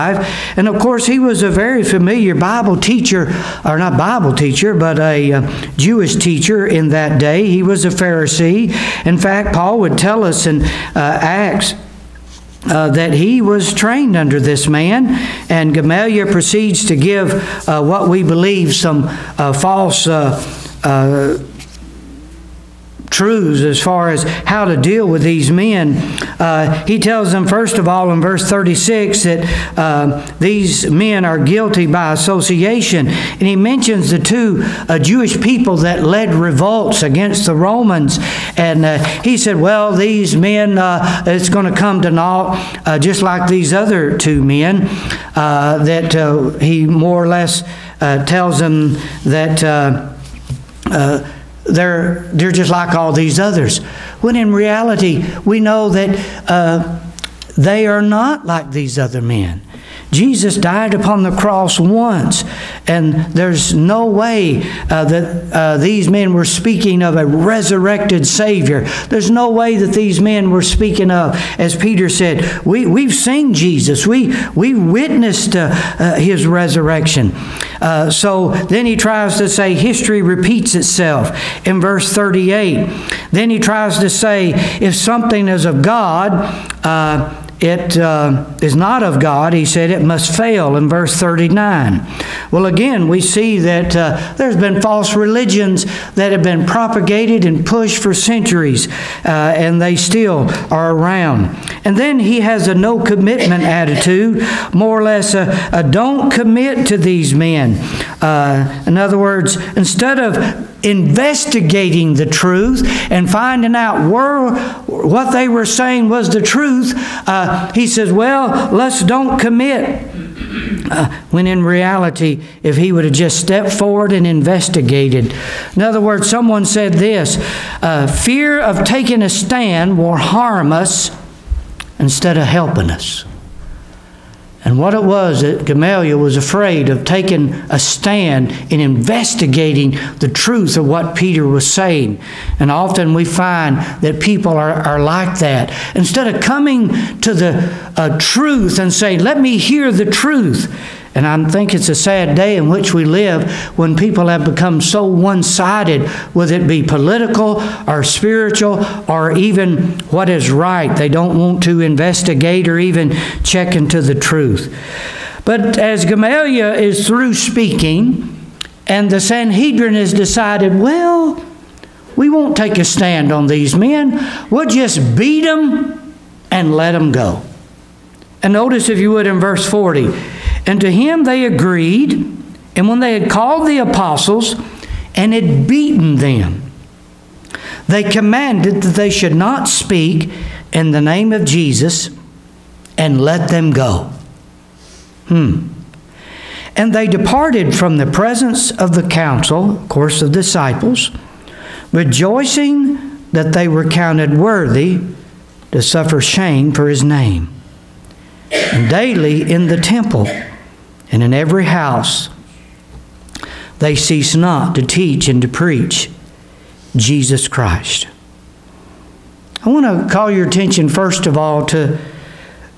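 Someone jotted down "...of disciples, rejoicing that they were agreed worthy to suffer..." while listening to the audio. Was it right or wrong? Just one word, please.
wrong.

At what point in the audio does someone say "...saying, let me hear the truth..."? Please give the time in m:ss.
2:28.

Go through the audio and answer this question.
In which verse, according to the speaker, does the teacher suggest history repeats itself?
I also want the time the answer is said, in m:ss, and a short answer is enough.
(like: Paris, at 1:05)
38, at 1:21.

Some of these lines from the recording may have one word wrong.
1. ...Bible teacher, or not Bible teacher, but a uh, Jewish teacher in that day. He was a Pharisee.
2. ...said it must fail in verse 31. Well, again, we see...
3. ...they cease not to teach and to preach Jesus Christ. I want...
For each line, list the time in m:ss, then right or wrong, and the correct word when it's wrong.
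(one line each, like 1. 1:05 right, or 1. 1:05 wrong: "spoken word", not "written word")
1. 0:02 right
2. 1:29 wrong: "39", not "31"
3. 3:33 right.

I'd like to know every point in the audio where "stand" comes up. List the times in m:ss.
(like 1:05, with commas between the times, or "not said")
2:09, 2:17, 2:52.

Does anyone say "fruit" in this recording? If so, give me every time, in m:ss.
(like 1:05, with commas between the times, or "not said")
not said.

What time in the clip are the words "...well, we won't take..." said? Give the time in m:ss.
2:50.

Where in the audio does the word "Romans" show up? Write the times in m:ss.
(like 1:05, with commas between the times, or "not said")
0:37.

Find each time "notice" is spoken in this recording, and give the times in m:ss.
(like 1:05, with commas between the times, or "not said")
2:58.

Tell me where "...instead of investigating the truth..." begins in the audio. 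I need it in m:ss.
1:49.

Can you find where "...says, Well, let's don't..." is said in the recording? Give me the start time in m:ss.
1:57.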